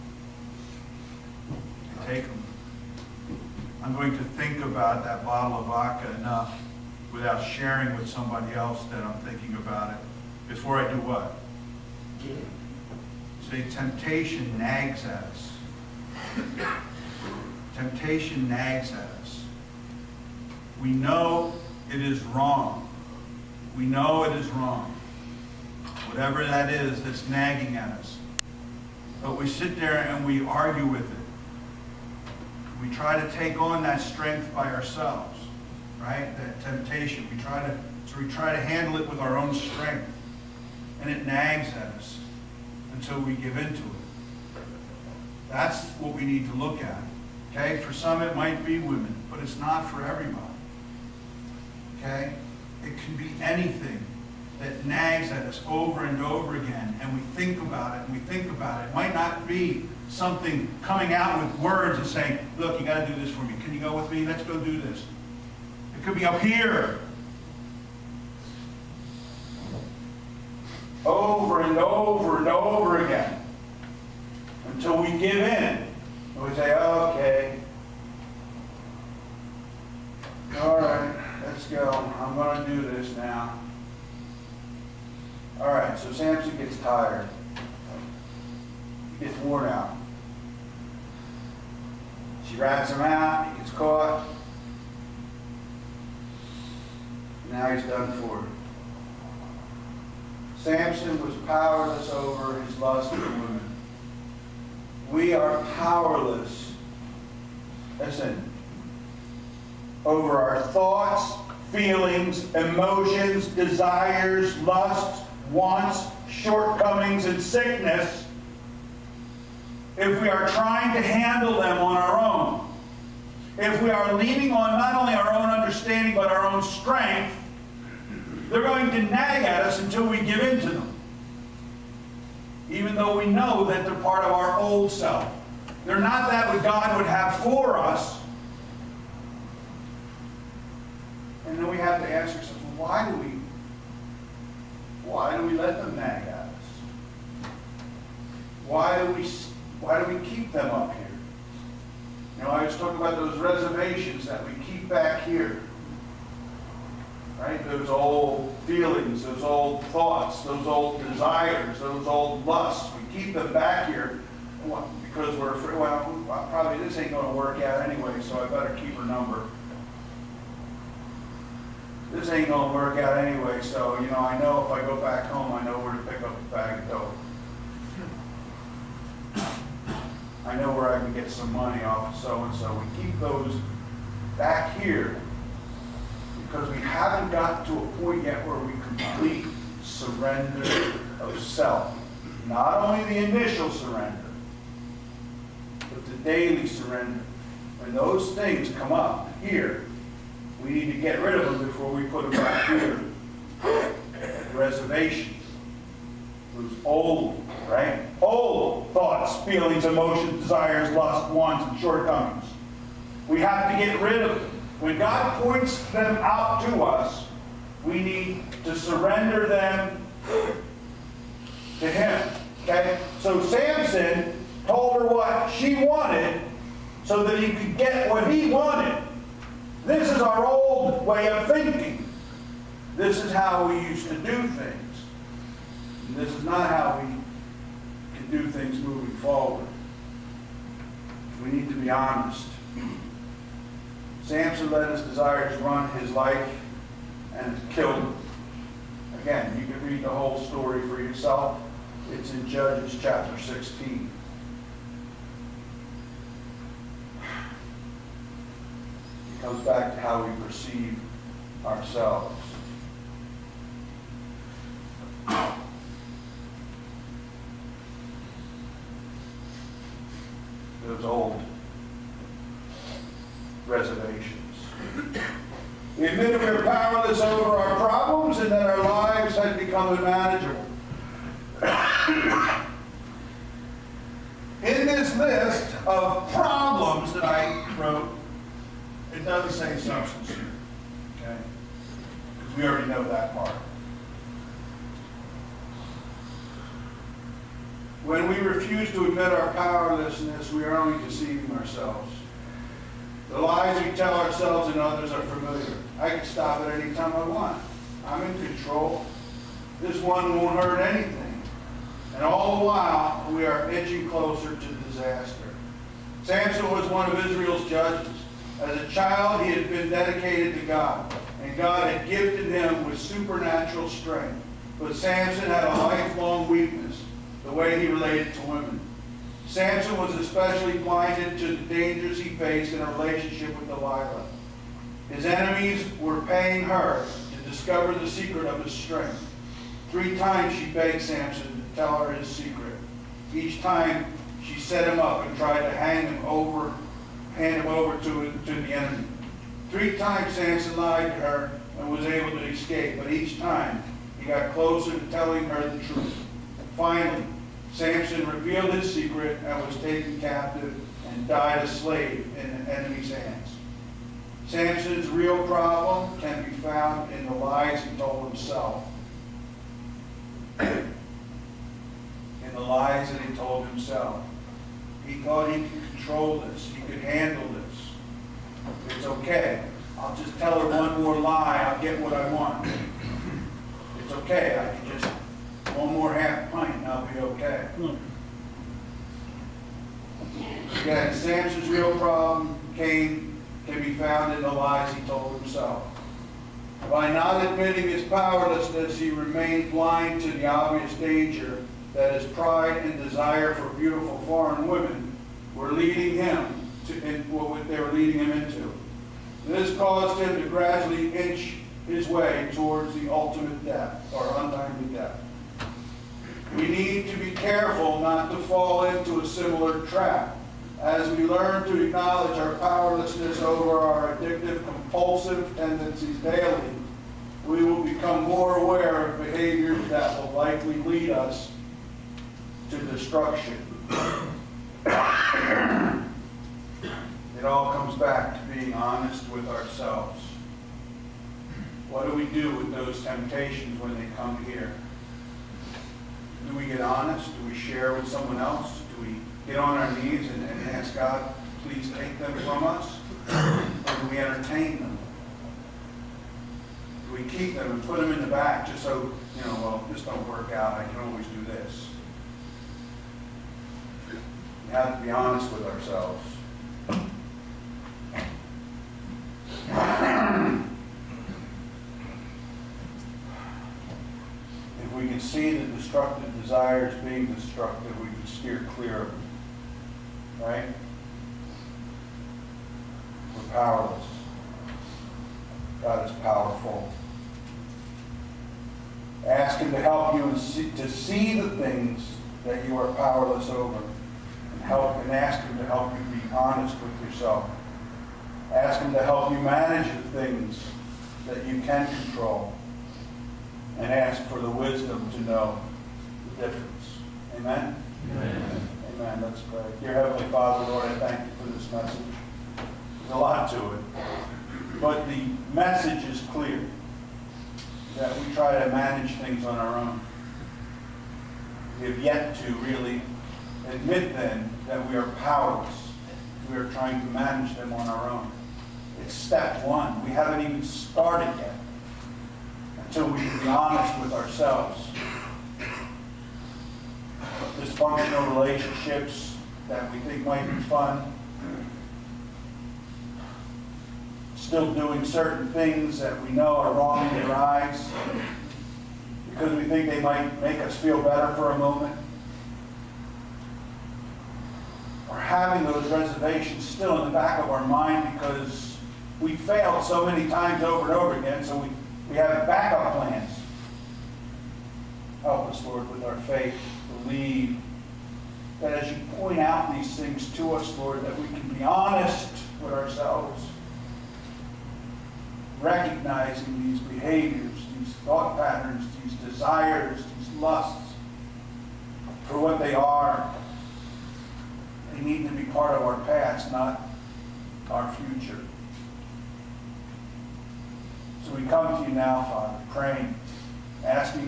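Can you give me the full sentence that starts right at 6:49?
This caused him to gradually inch his way towards the ultimate death or untimely death.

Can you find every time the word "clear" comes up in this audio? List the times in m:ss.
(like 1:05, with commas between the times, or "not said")
7:58, 8:36.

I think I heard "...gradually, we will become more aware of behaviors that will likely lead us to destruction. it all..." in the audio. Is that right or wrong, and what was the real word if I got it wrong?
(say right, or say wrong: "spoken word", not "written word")
wrong: "daily", not "gradually".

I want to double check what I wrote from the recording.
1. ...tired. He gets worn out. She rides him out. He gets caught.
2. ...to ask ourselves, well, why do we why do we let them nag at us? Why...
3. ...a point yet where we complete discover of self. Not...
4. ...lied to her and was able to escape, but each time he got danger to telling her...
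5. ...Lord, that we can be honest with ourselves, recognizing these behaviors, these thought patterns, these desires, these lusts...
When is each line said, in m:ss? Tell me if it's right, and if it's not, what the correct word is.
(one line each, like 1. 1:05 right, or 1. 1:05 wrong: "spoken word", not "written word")
1. 1:26 right
2. 2:22 right
3. 3:07 wrong: "surrender", not "discover"
4. 5:50 wrong: "closer", not "danger"
5. 9:30 right.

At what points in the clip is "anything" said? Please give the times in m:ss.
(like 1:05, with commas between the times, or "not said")
0:53, 5:10.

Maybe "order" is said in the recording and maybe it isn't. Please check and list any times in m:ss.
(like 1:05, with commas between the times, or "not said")
not said.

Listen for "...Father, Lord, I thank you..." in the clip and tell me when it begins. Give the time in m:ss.
8:30.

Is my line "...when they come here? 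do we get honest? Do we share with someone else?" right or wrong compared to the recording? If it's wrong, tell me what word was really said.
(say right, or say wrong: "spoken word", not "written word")
right.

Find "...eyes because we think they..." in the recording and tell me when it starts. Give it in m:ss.
9:07.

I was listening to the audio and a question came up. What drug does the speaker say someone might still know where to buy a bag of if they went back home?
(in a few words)
dope.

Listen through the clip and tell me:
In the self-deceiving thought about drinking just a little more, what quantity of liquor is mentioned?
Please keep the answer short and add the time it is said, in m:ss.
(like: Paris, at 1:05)
half pint, at 6:26.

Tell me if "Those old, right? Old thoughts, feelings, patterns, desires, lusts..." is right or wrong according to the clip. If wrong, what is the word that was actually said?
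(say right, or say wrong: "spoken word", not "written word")
wrong: "emotions", not "patterns".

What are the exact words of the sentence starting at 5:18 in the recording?
As a child, he had been dedicated to God, and God had gifted him with supernatural strength.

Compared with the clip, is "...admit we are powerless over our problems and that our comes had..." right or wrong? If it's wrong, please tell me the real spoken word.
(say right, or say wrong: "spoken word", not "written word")
wrong: "lives", not "comes".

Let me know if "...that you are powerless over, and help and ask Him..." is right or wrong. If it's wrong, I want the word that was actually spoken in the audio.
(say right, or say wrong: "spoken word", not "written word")
right.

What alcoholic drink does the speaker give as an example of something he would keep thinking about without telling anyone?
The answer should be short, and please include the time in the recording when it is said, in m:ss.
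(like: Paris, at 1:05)
vodka, at 0:05.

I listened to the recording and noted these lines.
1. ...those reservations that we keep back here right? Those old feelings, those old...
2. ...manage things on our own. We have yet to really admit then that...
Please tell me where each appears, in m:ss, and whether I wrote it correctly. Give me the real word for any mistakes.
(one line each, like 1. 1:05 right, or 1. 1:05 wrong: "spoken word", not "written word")
1. 2:33 right
2. 8:38 right.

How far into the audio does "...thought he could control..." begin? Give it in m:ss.
6:15.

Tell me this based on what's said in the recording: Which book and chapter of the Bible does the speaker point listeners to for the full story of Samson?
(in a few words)
Judges chapter 16.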